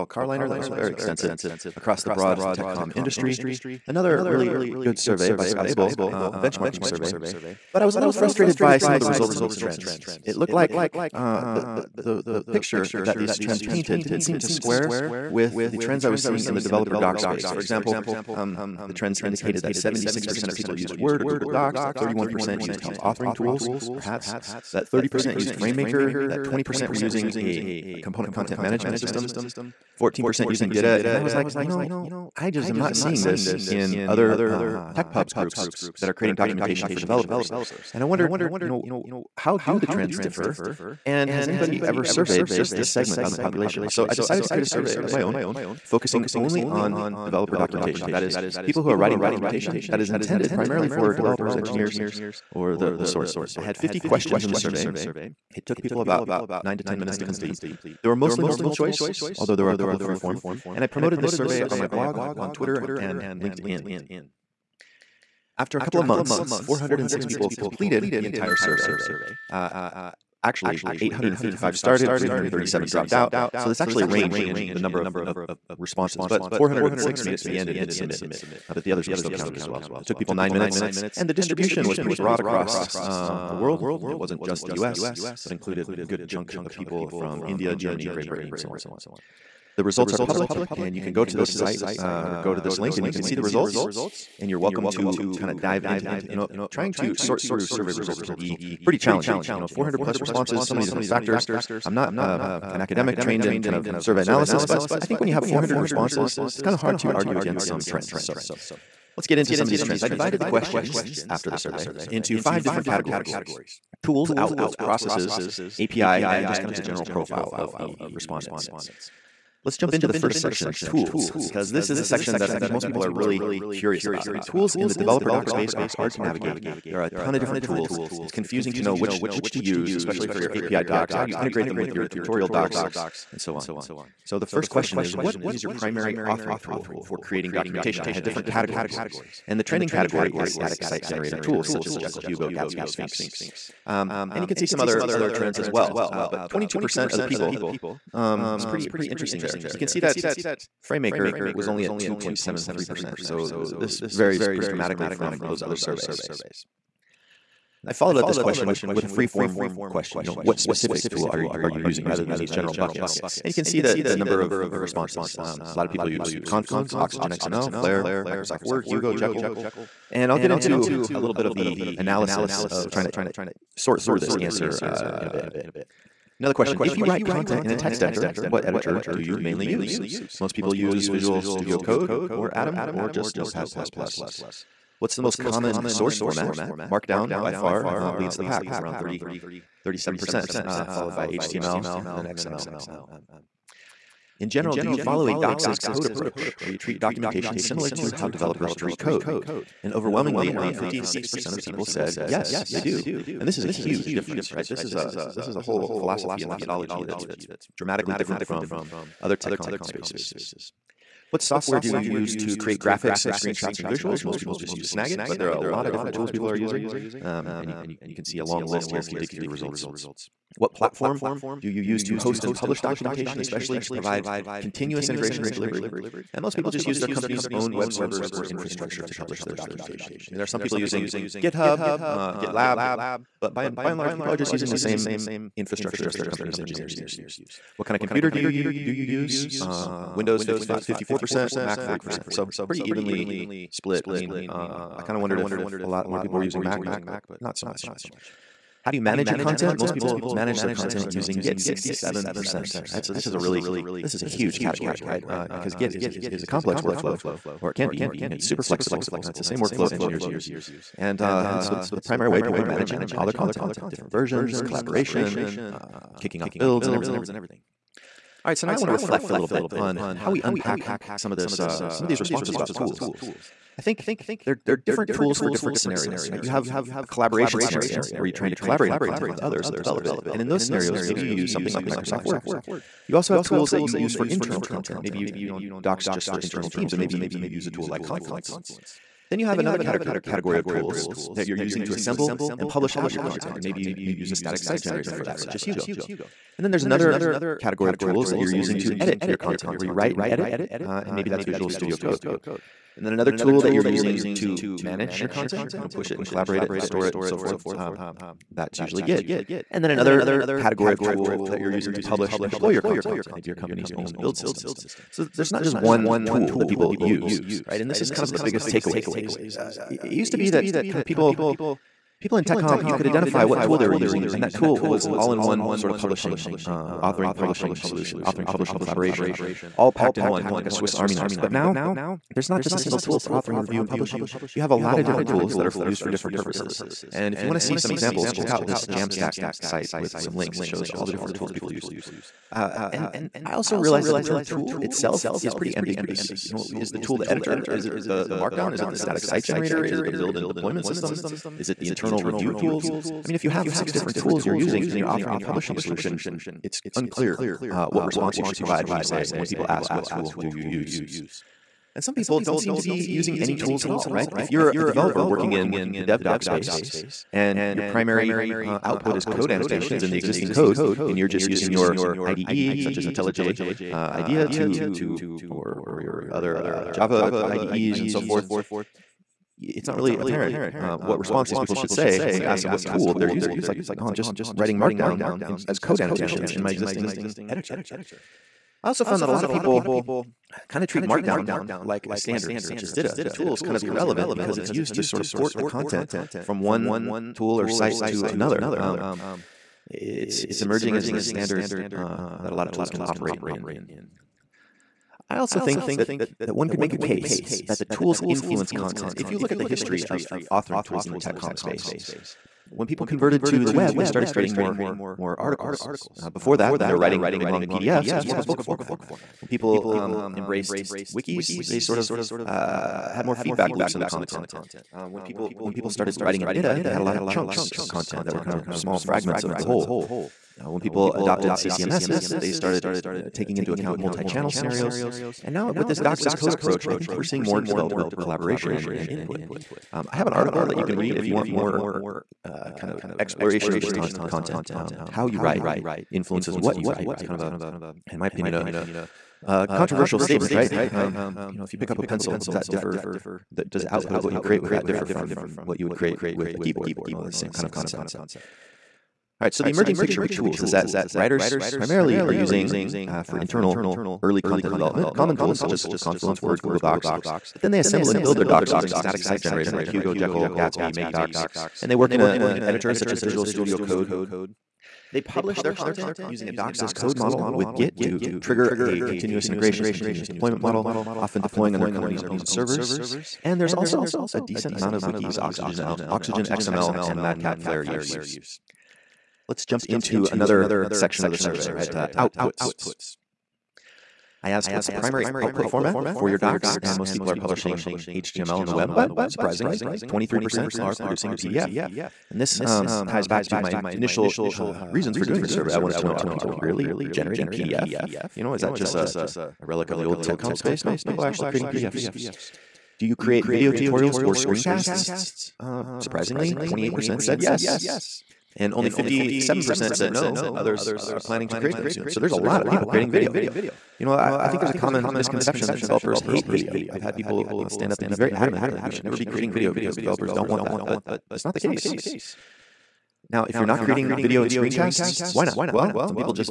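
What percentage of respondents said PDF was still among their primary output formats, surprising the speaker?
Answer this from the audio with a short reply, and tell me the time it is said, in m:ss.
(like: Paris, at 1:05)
23%, at 8:20.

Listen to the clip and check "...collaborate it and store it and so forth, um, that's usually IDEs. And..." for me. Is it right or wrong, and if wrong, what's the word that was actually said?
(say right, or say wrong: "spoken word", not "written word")
wrong: "Git", not "IDEs".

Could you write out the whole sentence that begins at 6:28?
I also found that a lot of people kind of treat Markdown like a standard, such as DITA.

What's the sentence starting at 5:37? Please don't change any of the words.
And if you want to see some examples, check out this Jamstack site with some links.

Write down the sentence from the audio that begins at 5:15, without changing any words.
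So there's not just one tool that people use, right?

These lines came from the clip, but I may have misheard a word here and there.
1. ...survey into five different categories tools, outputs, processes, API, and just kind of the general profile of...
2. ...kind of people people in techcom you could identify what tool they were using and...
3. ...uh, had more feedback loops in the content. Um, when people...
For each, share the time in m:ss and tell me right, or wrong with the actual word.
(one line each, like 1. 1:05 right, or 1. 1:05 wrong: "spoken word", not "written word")
1. 1:51 right
2. 5:20 right
3. 7:02 right.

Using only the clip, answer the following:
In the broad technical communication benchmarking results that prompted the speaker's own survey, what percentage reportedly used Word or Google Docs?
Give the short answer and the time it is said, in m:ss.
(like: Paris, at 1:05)
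76%, at 0:19.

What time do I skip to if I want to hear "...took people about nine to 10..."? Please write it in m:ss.
0:55.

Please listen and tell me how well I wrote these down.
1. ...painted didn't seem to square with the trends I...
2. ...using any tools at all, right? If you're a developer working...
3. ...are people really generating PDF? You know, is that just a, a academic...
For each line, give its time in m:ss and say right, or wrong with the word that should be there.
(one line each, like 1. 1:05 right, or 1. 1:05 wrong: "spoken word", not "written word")
1. 0:13 right
2. 6:03 right
3. 8:26 wrong: "relic", not "academic".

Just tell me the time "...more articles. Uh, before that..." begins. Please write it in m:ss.
6:55.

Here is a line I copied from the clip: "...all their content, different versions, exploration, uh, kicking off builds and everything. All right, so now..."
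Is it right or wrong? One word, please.
wrong.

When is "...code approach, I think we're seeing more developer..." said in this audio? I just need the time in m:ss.
7:16.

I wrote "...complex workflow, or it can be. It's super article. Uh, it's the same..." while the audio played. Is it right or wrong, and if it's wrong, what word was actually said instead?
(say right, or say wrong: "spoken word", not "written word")
wrong: "flexible", not "article".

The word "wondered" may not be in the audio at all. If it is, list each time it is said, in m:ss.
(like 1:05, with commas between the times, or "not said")
0:38, 4:05.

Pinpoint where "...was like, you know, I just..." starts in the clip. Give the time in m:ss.
0:31.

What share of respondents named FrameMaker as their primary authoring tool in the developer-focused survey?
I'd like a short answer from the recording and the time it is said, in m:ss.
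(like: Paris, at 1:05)
2.73%, at 2:31.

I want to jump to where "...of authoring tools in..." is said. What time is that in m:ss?
6:50.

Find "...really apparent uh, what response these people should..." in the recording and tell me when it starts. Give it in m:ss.
6:19.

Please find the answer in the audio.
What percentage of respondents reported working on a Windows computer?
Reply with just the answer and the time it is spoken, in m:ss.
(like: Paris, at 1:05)
54%, at 4:00.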